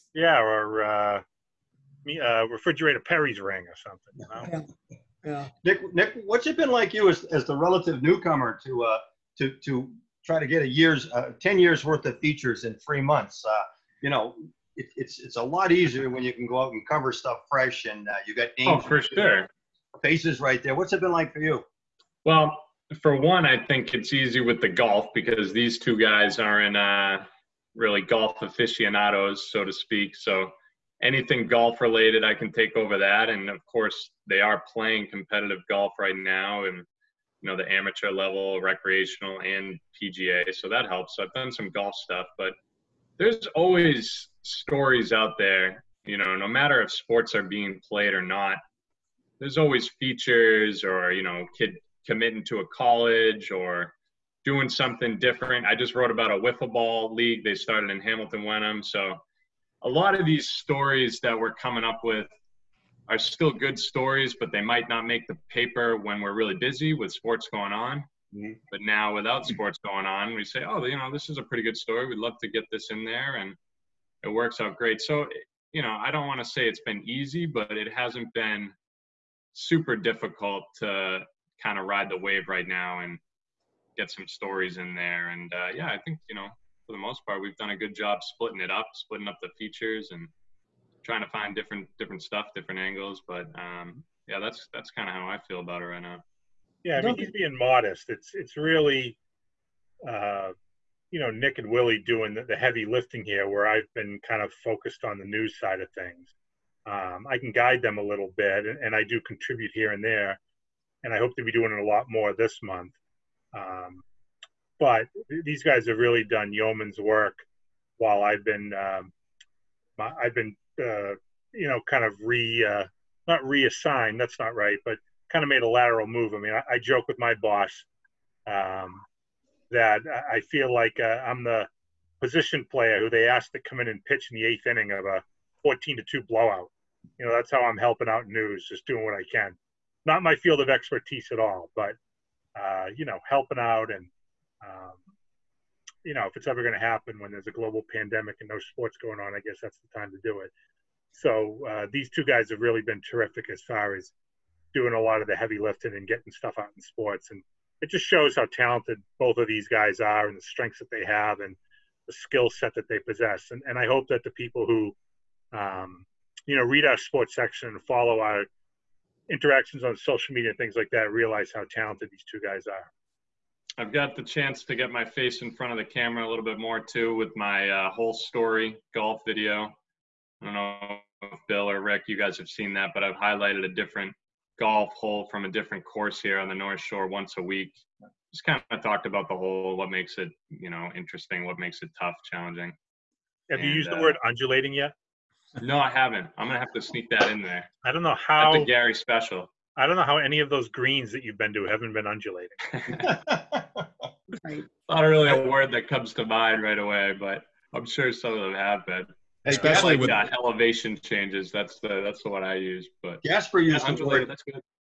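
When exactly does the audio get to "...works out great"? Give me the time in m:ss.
1:14.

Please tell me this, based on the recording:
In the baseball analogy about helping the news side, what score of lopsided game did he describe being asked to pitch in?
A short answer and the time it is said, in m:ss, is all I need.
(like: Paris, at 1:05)
14 to 2, at 2:15.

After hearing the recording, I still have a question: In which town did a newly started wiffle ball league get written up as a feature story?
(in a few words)
Hamilton Wenham.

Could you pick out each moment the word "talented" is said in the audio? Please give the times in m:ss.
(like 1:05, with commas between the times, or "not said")
2:38, 2:51.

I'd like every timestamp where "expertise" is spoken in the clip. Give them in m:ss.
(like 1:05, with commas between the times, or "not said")
2:20.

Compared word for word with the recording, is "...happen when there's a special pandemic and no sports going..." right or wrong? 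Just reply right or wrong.
wrong.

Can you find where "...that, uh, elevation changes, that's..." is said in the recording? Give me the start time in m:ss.
3:30.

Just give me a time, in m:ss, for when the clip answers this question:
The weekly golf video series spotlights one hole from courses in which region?
3:06.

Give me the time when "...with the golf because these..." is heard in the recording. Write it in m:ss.
0:24.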